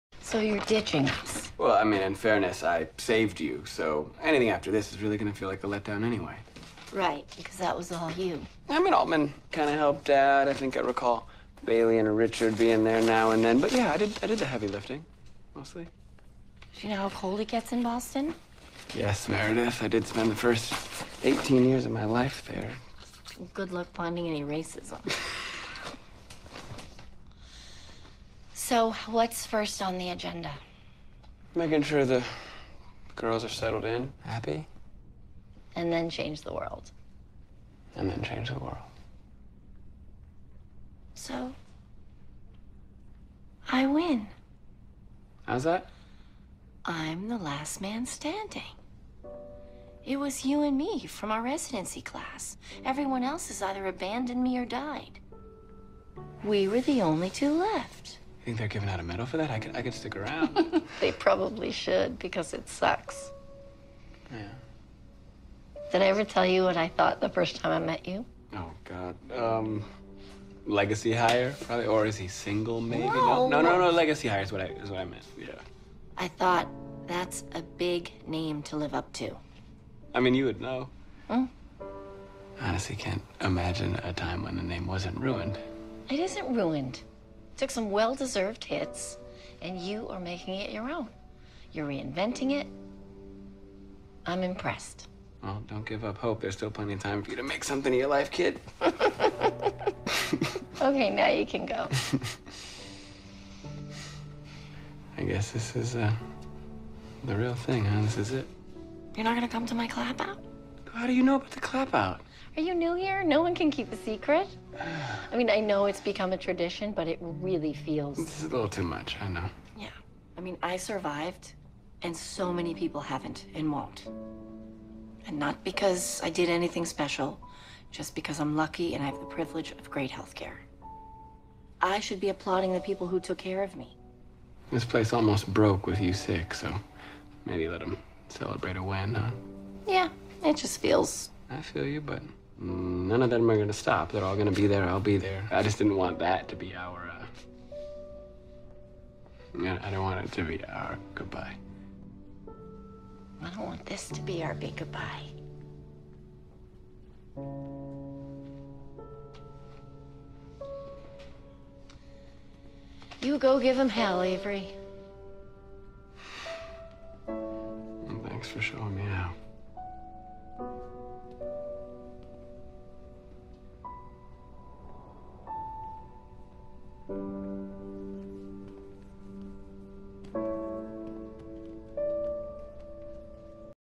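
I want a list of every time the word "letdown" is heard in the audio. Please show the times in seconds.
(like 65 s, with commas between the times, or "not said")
5 s.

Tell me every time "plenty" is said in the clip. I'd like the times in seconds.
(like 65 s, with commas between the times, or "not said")
96 s.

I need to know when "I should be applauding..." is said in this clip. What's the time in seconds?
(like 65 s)
131 s.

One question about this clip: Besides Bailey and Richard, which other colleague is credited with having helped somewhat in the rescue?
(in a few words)
Altman.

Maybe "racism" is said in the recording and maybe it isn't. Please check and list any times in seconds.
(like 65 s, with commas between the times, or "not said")
24 s.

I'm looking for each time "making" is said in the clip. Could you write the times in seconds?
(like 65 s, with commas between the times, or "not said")
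31 s, 90 s.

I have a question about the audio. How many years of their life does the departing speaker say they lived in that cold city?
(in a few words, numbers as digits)
18.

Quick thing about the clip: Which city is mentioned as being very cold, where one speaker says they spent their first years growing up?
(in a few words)
Boston.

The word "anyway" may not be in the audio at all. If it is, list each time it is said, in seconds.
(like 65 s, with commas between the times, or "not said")
6 s.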